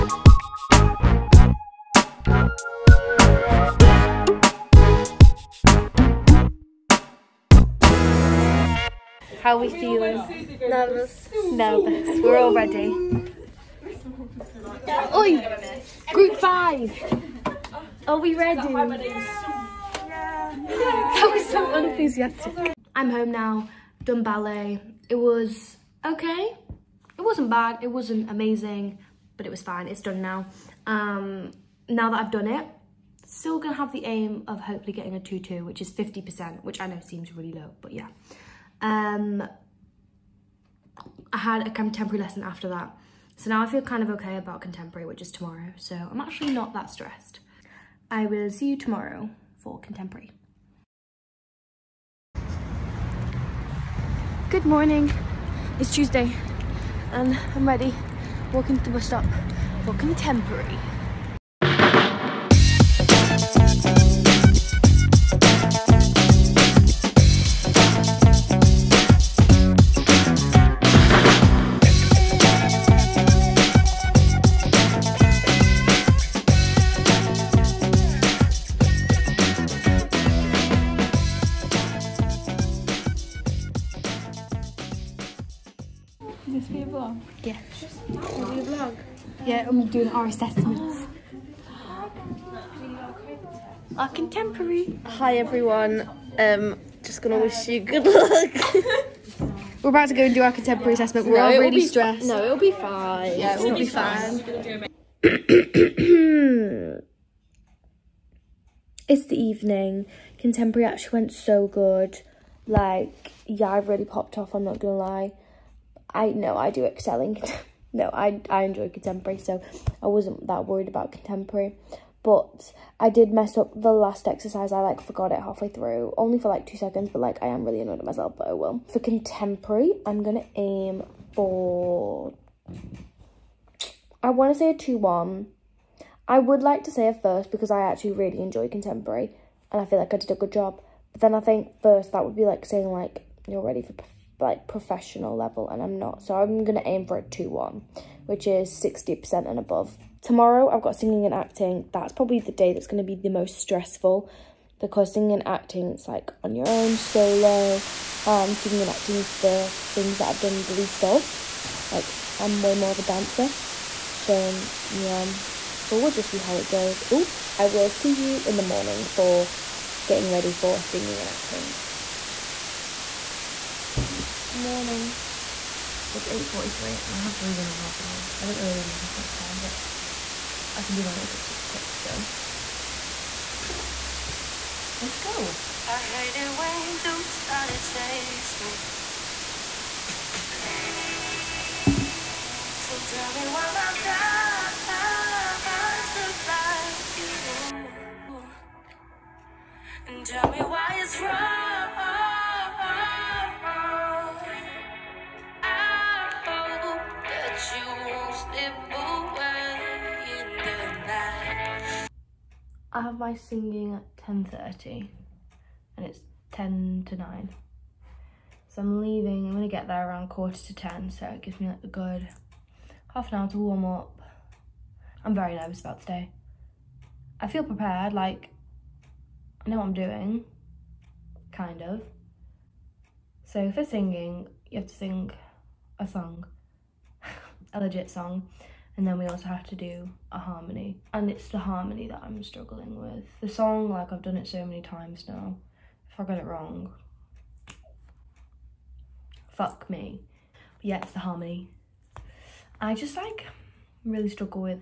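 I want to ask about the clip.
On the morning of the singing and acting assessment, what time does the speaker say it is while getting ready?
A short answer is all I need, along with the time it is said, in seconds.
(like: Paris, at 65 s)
8.43, at 176 s.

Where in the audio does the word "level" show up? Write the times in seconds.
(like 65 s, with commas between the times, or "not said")
145 s.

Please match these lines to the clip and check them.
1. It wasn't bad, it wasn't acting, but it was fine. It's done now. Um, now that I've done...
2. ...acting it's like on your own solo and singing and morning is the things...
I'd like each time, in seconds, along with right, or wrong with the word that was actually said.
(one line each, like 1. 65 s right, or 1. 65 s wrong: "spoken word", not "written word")
1. 27 s wrong: "amazing", not "acting"
2. 155 s wrong: "acting", not "morning".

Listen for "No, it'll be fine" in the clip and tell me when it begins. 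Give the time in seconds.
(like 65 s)
102 s.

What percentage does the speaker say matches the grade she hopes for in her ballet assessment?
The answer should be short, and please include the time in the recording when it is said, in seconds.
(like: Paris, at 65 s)
50%, at 35 s.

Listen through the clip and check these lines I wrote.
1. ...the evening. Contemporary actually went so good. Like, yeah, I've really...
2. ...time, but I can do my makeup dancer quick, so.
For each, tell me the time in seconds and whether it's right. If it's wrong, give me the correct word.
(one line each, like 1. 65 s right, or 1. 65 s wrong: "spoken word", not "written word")
1. 109 s right
2. 179 s wrong: "super", not "dancer".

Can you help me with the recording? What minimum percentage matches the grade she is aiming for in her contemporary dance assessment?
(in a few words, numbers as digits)
60%.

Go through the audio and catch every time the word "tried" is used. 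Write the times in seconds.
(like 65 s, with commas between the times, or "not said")
not said.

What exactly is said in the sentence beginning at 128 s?
For contemporary, I'm going to aim for...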